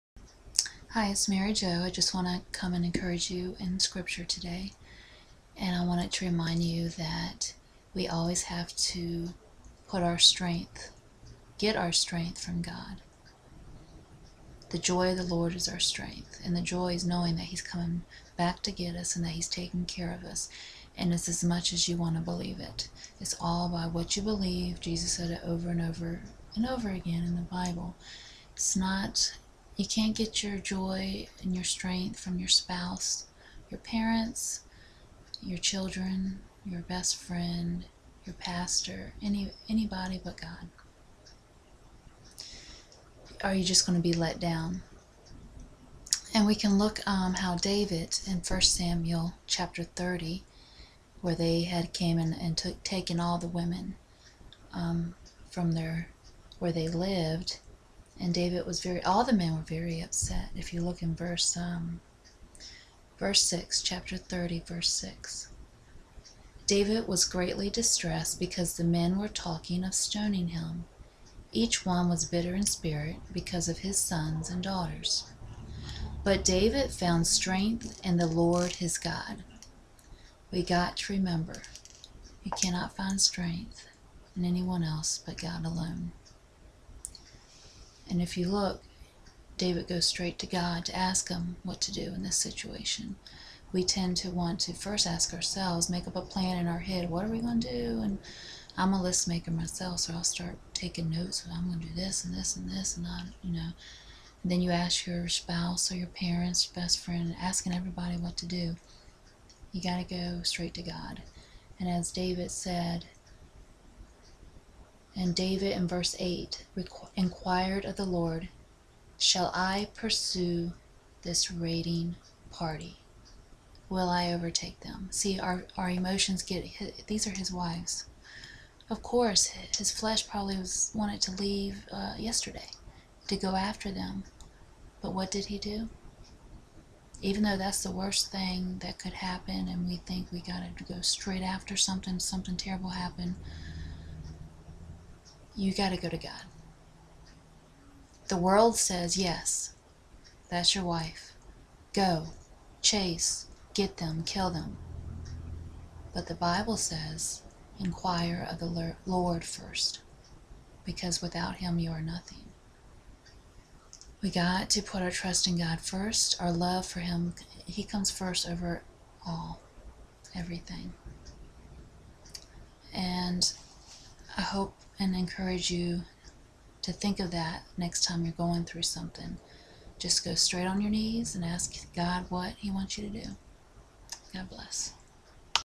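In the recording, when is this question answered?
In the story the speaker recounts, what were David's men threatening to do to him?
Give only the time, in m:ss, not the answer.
1:09.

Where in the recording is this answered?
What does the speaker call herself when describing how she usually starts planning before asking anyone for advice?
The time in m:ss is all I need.
1:38.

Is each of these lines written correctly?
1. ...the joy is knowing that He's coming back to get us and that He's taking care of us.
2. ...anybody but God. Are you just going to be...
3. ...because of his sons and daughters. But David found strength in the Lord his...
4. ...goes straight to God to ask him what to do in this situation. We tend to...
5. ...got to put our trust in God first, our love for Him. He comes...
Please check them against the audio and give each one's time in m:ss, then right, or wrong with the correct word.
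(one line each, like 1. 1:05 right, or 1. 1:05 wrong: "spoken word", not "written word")
1. 0:16 right
2. 0:39 right
3. 1:13 right
4. 1:29 right
5. 2:44 right.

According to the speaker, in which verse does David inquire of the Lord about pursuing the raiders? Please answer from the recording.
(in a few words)
verse 8.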